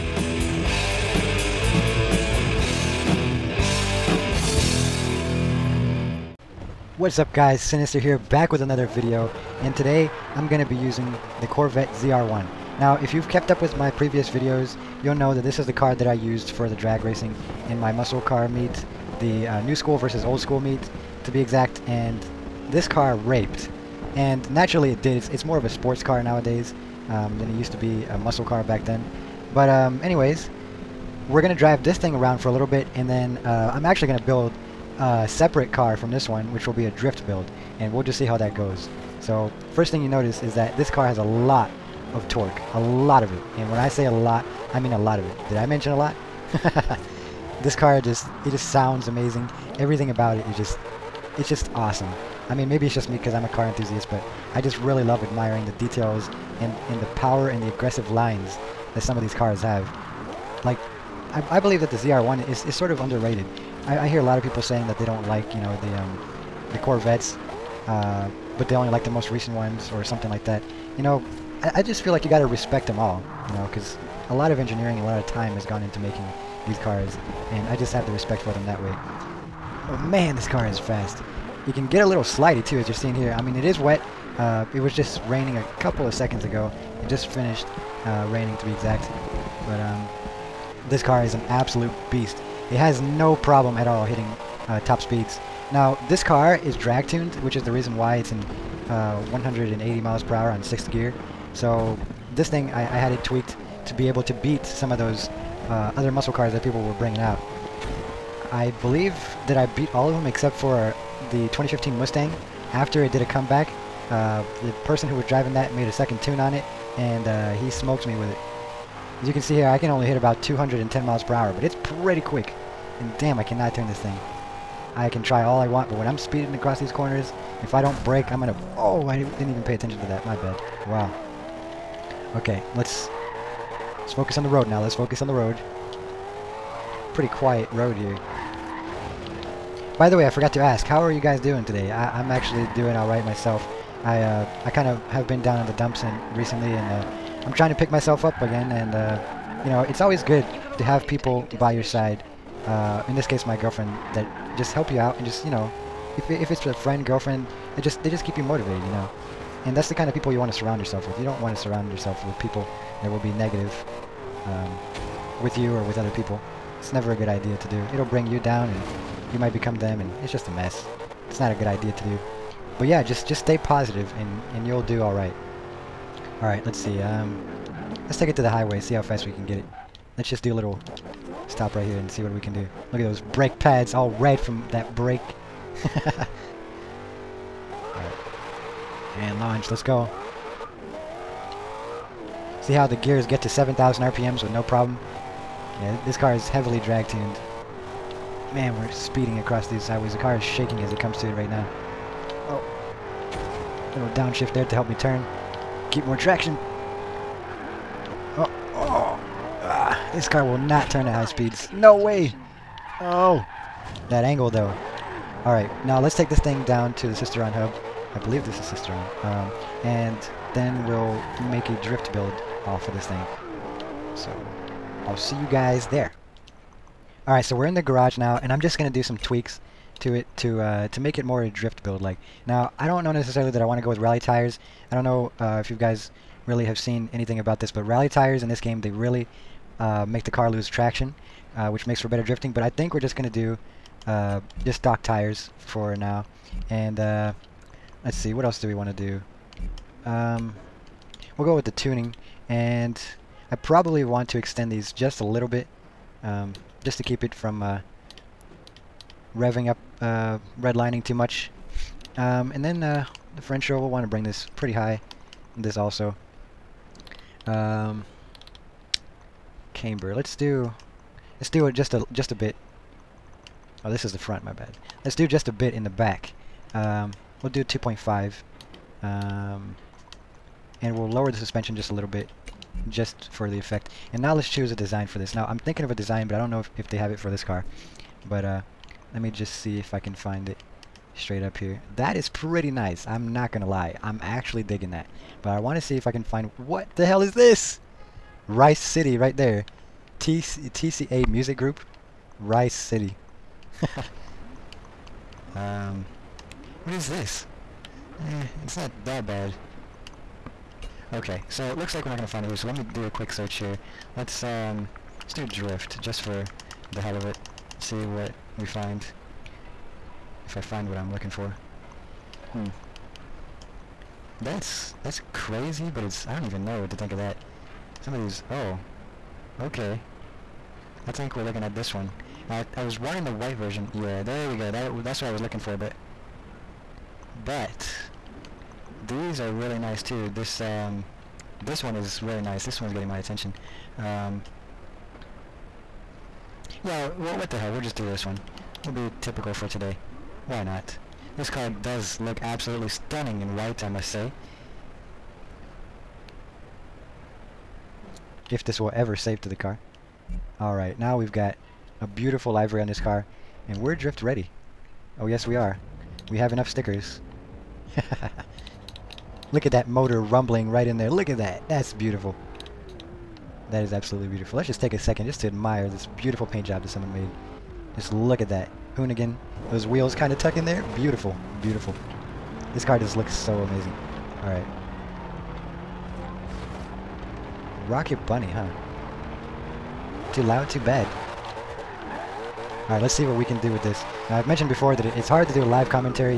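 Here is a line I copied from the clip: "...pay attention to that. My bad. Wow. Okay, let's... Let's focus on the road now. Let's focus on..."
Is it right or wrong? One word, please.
right.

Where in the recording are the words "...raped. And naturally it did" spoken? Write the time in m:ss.
0:23.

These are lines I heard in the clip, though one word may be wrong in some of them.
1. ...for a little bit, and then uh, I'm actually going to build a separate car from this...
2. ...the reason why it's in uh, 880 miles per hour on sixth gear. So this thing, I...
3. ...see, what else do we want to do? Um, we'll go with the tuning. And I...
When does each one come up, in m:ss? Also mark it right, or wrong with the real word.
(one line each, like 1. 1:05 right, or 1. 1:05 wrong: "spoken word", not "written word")
1. 0:32 right
2. 1:37 wrong: "180", not "880"
3. 4:08 right.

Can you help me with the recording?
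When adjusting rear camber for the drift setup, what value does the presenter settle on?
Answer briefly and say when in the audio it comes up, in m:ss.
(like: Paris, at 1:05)
2.5, at 4:37.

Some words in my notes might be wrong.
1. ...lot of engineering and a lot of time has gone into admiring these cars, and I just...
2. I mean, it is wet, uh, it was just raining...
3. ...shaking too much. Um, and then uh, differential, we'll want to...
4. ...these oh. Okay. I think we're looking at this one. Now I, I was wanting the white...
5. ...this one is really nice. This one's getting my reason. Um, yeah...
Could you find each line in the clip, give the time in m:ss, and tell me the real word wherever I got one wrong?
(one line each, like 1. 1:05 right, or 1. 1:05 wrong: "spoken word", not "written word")
1. 1:14 wrong: "making", not "admiring"
2. 1:23 right
3. 4:20 wrong: "redlining", not "shaking"
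4. 5:28 right
5. 5:41 wrong: "attention", not "reason".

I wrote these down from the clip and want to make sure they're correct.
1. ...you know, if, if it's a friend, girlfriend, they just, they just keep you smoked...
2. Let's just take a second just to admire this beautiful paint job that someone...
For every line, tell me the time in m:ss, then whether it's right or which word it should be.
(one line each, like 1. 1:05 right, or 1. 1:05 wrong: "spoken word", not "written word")
1. 2:35 wrong: "motivated", not "smoked"
2. 6:14 right.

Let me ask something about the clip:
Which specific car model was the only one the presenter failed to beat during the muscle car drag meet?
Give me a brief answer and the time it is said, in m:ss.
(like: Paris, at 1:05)
2015 Mustang, at 1:51.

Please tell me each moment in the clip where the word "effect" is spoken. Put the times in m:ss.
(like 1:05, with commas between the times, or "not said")
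4:43.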